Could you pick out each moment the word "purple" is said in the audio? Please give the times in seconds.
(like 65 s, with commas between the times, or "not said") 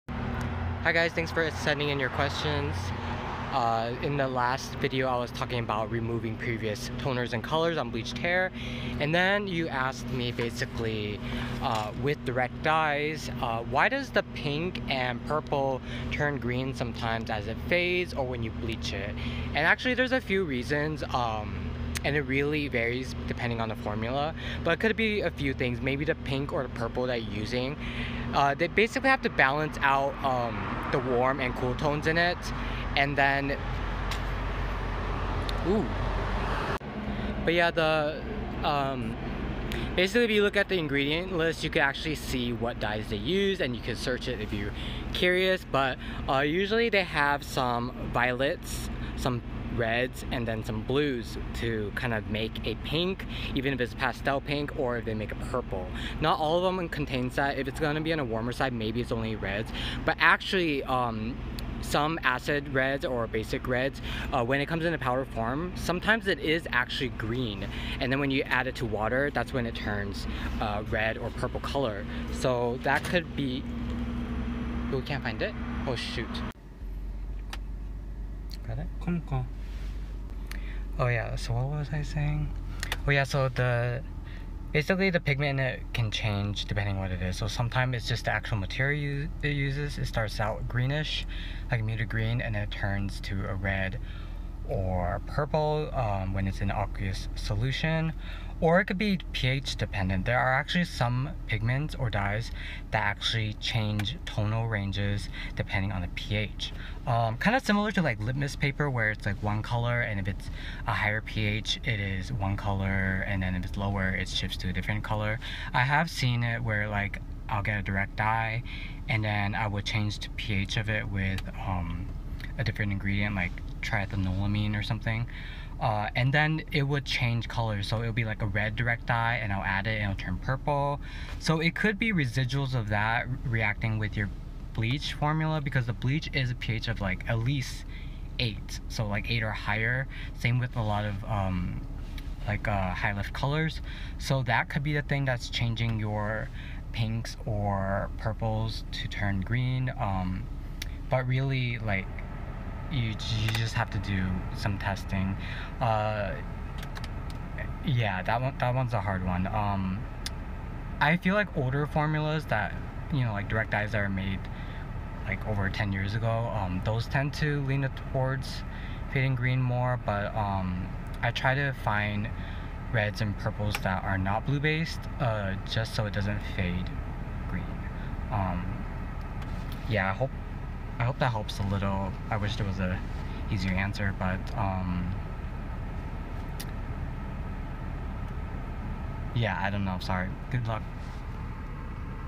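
15 s, 26 s, 55 s, 71 s, 95 s, 130 s, 148 s, 173 s.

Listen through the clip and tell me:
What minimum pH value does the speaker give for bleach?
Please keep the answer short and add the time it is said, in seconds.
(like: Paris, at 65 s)
8, at 137 s.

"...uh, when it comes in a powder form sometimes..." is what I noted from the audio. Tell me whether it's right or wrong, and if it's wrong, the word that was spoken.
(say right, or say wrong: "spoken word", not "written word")
right.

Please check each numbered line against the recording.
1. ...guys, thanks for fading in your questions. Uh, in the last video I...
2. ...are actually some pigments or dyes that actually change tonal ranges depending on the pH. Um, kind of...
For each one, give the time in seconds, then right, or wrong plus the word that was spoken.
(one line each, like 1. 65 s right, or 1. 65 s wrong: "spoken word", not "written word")
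1. 0 s wrong: "sending", not "fading"
2. 100 s right.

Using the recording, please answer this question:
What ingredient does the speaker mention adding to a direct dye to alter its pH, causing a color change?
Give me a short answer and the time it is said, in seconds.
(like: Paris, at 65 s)
triethanolamine, at 123 s.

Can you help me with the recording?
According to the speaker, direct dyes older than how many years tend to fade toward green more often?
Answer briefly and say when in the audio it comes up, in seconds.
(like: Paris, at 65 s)
10 years, at 165 s.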